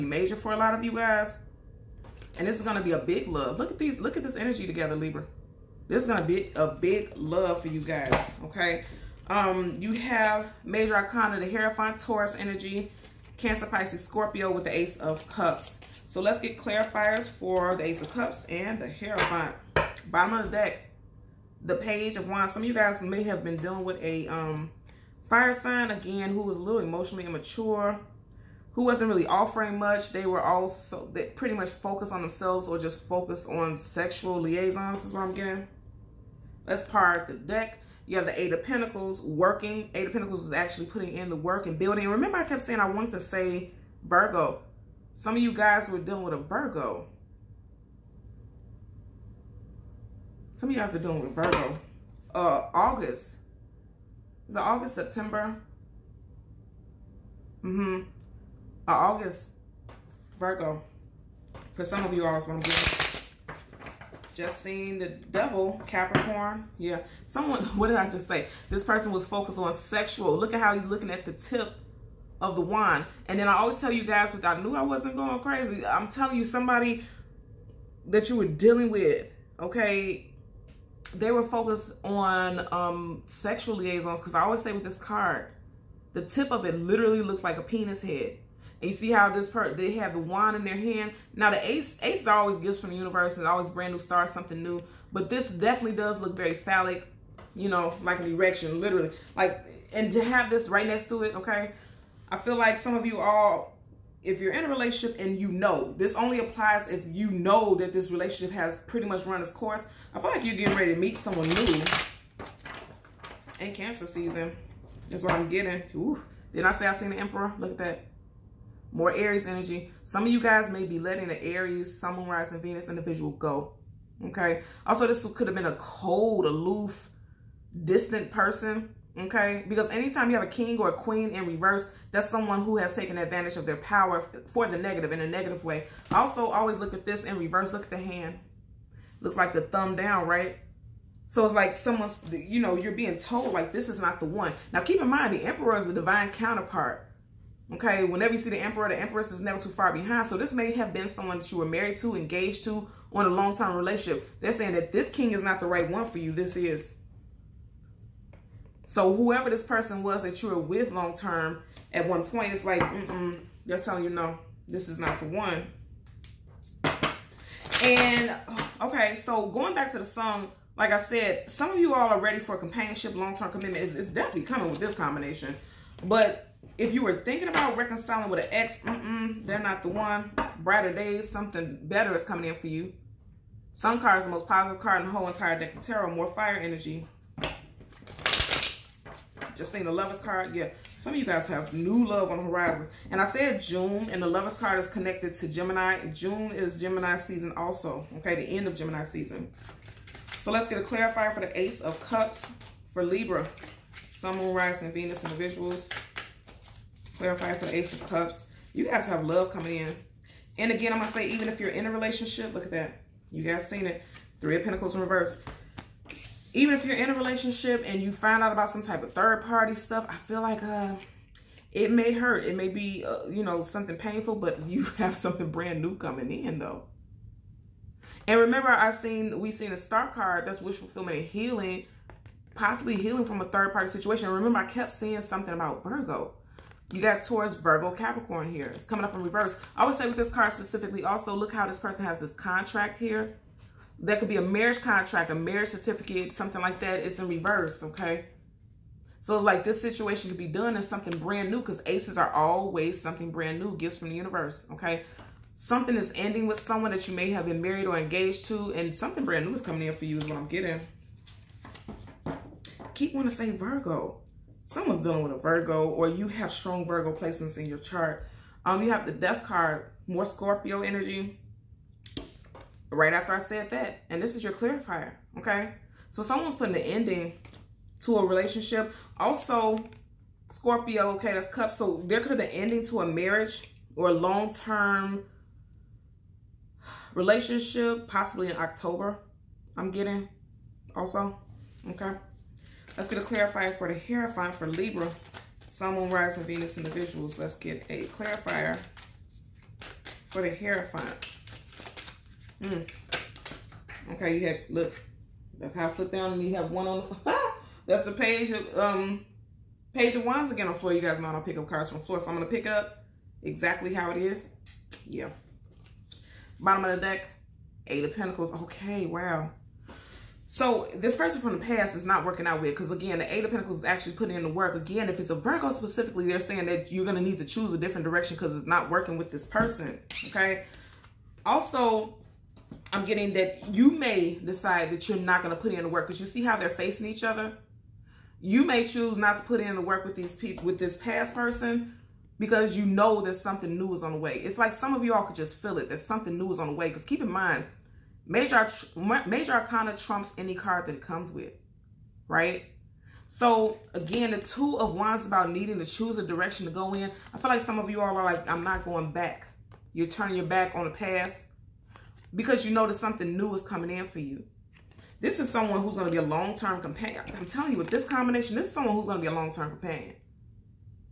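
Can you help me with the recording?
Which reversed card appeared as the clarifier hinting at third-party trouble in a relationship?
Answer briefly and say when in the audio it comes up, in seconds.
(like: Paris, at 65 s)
Three of Pentacles, at 214 s.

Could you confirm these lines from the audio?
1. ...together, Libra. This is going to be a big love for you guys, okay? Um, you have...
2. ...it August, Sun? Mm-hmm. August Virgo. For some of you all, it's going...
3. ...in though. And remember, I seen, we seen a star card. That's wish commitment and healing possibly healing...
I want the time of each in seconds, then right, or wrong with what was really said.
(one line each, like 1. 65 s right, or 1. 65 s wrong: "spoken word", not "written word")
1. 4 s right
2. 54 s wrong: "September", not "Sun"
3. 226 s wrong: "fulfillment", not "commitment".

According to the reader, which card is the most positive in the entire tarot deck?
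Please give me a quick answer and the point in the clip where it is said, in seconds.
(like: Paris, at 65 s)
Sun card, at 183 s.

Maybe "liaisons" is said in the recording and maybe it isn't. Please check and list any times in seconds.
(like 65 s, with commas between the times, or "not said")
34 s, 83 s.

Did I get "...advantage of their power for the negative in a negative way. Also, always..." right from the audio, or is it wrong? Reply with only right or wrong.
right.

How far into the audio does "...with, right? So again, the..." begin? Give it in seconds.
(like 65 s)
351 s.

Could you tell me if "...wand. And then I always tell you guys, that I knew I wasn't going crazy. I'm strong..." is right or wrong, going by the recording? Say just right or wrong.
wrong.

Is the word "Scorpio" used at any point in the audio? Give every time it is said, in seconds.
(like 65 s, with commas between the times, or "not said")
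14 s, 270 s, 280 s.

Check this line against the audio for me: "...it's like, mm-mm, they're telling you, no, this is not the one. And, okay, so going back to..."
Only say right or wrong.
right.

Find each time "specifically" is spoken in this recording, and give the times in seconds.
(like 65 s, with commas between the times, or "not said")
240 s, 325 s.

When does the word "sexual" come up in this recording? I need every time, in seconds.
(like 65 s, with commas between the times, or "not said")
33 s, 69 s, 83 s.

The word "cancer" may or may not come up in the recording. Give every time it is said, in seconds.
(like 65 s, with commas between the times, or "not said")
13 s, 113 s.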